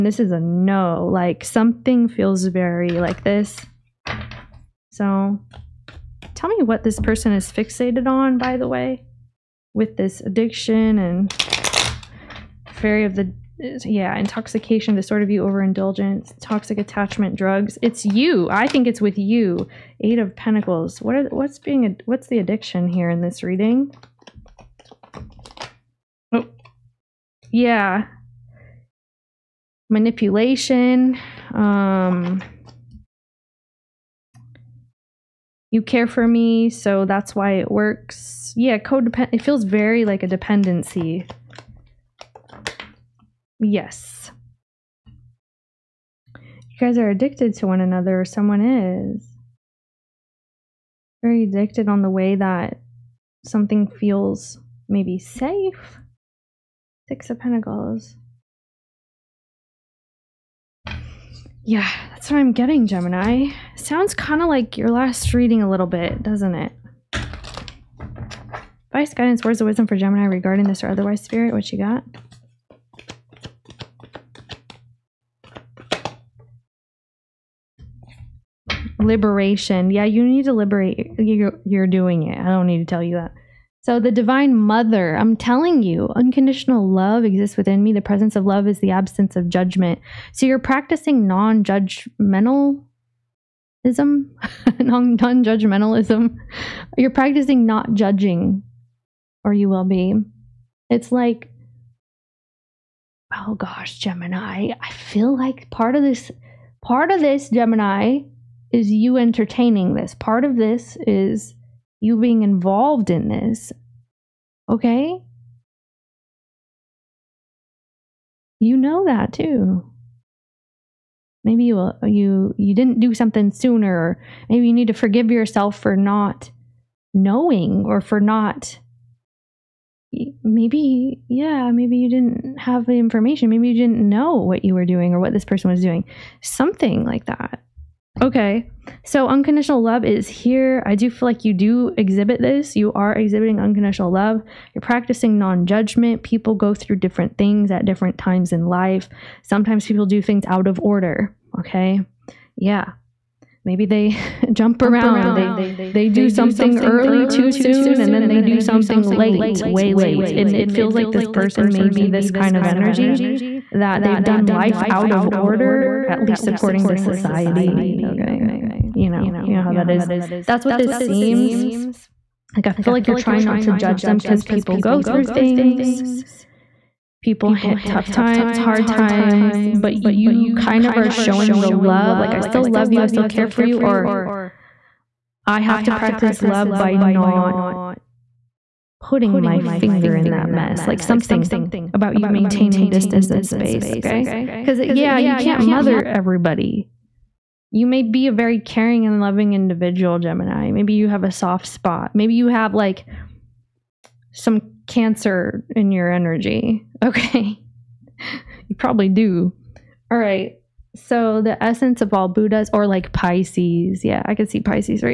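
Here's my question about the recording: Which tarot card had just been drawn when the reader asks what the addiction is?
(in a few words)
Eight of Pentacles.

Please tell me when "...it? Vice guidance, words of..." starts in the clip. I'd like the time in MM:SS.
01:06.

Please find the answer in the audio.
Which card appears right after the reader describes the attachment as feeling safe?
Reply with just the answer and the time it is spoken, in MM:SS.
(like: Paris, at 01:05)
Six of Pentacles, at 00:57.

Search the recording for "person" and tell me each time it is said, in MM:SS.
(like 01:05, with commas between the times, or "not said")
00:06, 02:15, 02:41.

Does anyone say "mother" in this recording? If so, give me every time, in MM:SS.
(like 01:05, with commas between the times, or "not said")
01:24, 03:15.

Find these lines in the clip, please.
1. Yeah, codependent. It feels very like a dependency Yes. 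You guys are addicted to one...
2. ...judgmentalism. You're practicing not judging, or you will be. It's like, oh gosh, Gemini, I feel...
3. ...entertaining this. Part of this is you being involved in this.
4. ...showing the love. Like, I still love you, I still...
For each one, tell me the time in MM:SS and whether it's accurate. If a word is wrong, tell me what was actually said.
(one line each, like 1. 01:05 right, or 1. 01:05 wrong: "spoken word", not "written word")
1. 00:38 right
2. 01:35 right
3. 01:49 right
4. 03:01 right.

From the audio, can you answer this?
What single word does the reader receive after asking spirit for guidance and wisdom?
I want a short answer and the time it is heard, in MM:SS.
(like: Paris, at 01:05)
Liberation, at 01:19.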